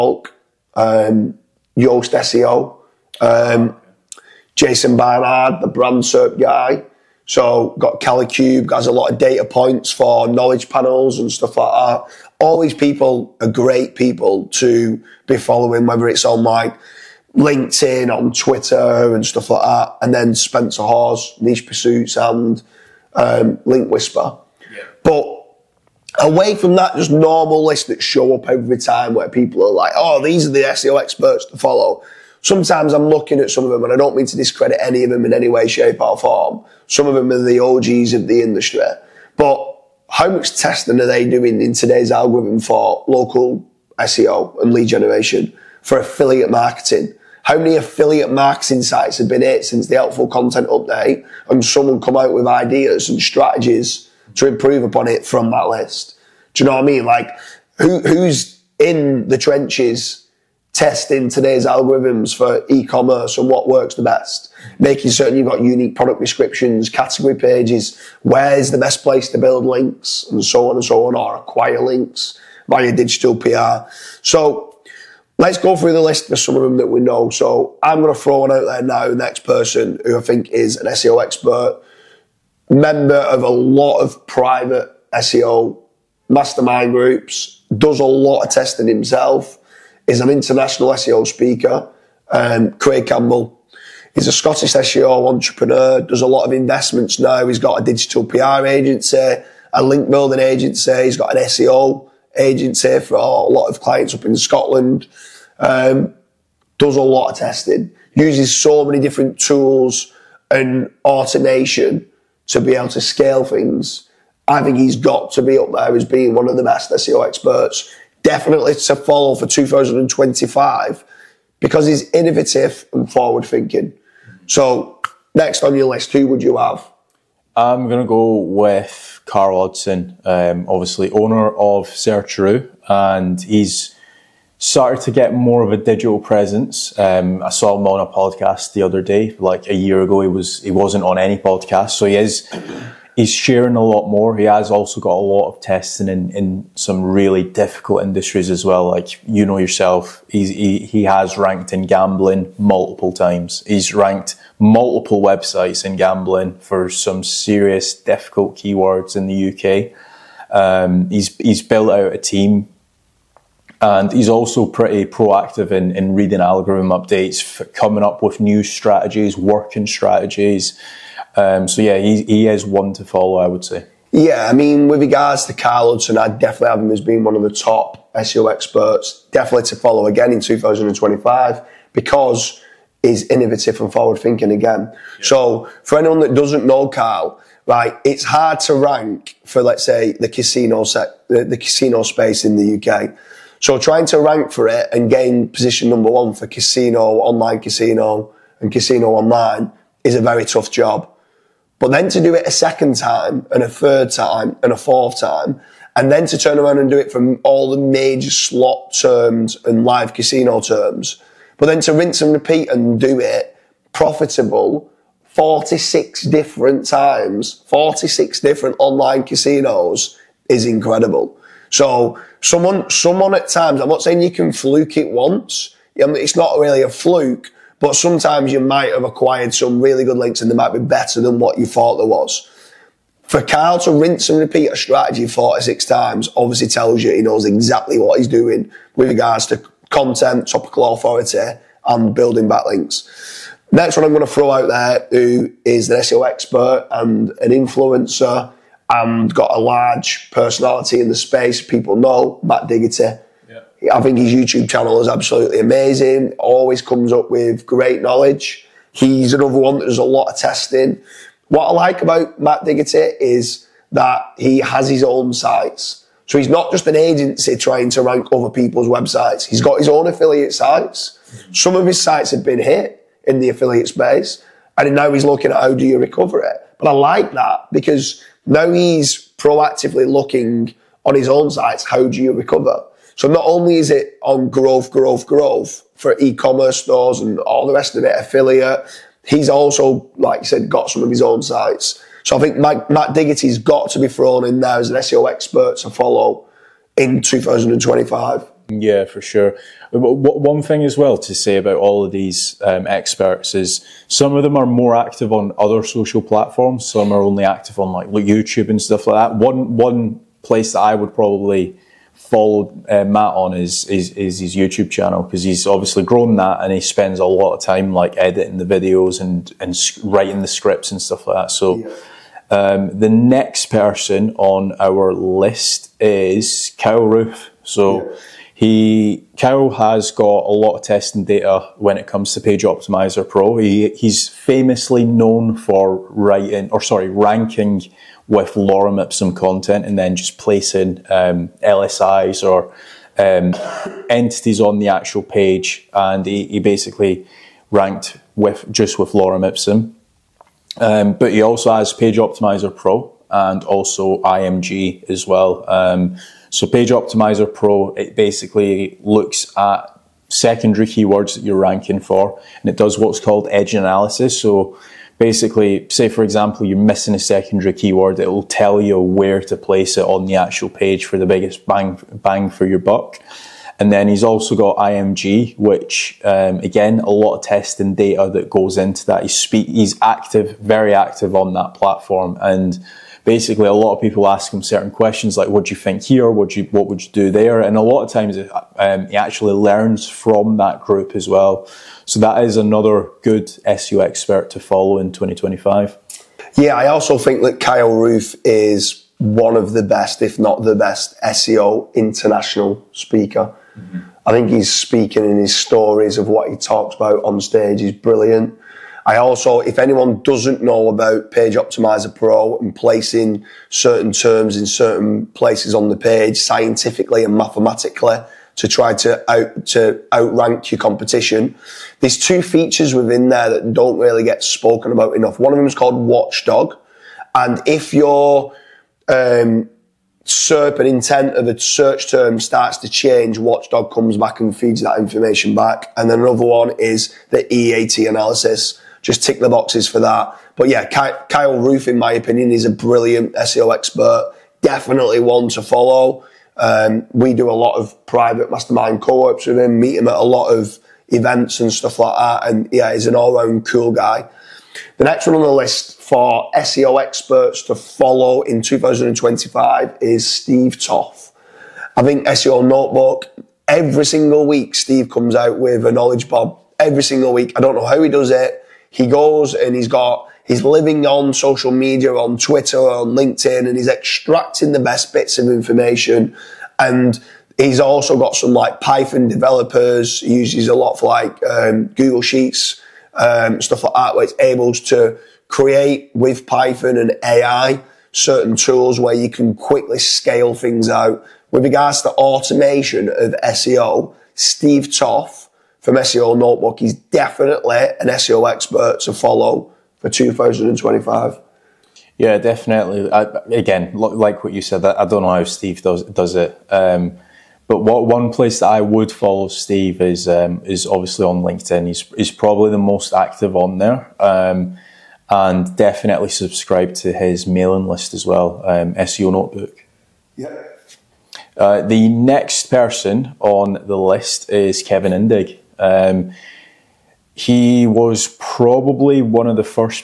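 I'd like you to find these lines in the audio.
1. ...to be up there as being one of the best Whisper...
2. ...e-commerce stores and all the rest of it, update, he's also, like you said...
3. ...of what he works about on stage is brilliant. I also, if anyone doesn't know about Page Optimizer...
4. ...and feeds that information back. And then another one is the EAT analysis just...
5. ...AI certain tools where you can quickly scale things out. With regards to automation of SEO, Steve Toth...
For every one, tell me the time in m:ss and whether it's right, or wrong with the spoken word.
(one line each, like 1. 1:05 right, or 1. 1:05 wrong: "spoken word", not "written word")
1. 1:55 wrong: "SEO", not "Whisper"
2. 4:46 wrong: "affiliate", not "update"
3. 6:46 wrong: "talks", not "works"
4. 7:14 right
5. 8:07 right.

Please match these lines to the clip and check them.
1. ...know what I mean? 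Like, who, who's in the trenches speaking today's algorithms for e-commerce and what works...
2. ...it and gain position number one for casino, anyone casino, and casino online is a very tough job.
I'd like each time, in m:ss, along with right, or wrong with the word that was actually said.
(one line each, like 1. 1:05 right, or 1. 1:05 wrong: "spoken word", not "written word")
1. 0:56 wrong: "testing", not "speaking"
2. 3:14 wrong: "online", not "anyone".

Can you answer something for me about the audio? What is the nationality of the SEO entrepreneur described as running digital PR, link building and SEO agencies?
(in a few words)
Scottish.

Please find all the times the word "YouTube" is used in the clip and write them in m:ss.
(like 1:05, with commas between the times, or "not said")
4:14, 5:08, 5:14.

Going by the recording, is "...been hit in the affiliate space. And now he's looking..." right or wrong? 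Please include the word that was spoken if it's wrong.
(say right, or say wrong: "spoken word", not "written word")
right.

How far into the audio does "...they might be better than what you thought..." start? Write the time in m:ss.
3:50.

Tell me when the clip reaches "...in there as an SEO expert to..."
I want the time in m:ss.
4:54.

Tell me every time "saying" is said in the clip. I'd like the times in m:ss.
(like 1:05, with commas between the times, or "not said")
3:44.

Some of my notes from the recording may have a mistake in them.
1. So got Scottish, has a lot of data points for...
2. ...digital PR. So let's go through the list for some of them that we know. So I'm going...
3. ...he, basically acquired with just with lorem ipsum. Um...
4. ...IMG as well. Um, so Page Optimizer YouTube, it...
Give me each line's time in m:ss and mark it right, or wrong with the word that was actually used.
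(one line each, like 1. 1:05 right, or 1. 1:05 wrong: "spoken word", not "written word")
1. 0:07 wrong: "Kalicube", not "Scottish"
2. 1:12 right
3. 5:46 wrong: "ranked", not "acquired"
4. 5:54 wrong: "Pro", not "YouTube".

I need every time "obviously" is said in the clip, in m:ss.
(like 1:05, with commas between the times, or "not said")
2:10, 3:56, 5:15, 8:30.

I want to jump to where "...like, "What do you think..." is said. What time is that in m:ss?
6:25.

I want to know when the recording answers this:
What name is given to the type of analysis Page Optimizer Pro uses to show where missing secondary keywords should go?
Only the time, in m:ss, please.
6:03.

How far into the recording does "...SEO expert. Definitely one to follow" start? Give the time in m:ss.
7:23.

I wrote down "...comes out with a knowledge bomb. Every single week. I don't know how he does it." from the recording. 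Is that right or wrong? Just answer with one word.
right.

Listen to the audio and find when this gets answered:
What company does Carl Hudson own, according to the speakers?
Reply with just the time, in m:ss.
2:11.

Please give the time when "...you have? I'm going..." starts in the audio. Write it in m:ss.
2:06.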